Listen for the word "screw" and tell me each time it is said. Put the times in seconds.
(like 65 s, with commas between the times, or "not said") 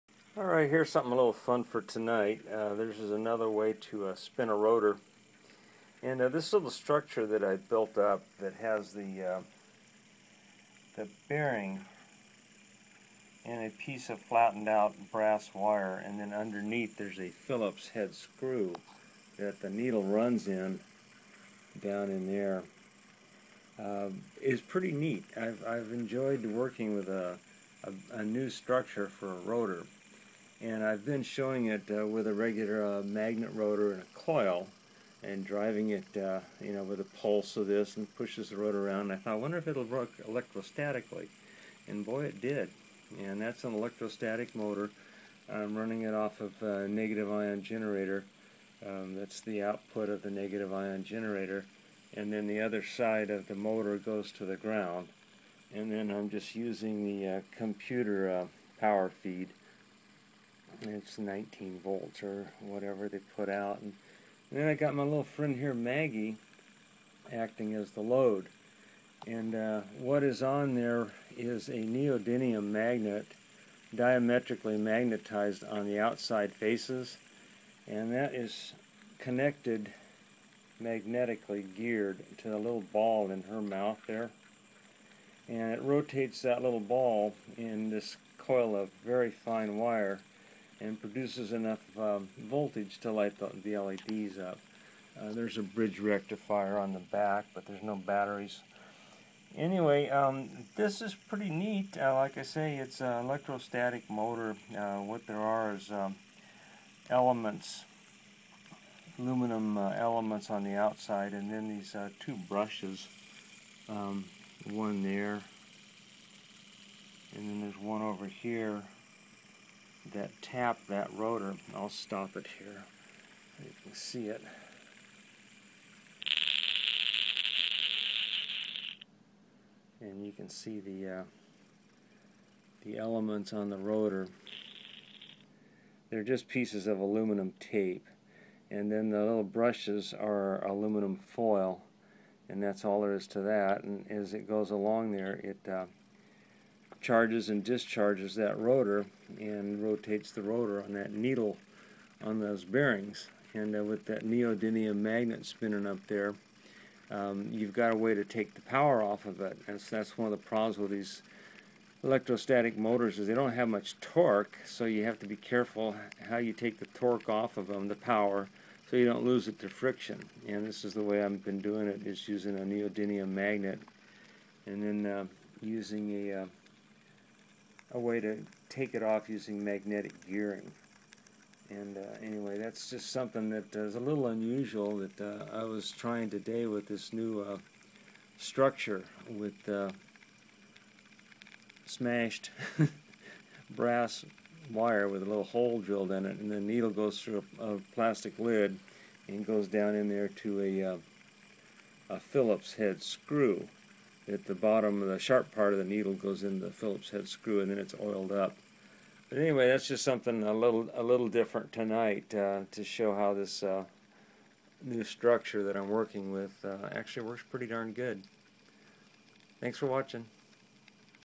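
18 s, 203 s, 207 s.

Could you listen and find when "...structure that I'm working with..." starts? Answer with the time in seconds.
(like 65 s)
215 s.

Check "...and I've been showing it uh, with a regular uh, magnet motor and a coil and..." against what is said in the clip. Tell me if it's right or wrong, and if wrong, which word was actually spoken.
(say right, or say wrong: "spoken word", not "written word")
wrong: "rotor", not "motor".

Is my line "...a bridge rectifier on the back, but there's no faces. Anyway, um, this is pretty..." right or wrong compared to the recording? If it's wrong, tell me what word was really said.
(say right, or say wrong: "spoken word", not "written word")
wrong: "batteries", not "faces".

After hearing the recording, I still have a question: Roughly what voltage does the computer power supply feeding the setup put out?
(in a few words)
19 volts.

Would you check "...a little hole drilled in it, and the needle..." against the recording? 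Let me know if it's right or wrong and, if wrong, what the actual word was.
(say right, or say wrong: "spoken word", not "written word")
right.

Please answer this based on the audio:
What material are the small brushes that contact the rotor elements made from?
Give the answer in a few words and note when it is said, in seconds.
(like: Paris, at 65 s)
Aluminum foil, at 140 s.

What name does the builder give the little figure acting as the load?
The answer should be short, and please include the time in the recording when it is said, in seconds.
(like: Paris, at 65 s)
Maggie, at 65 s.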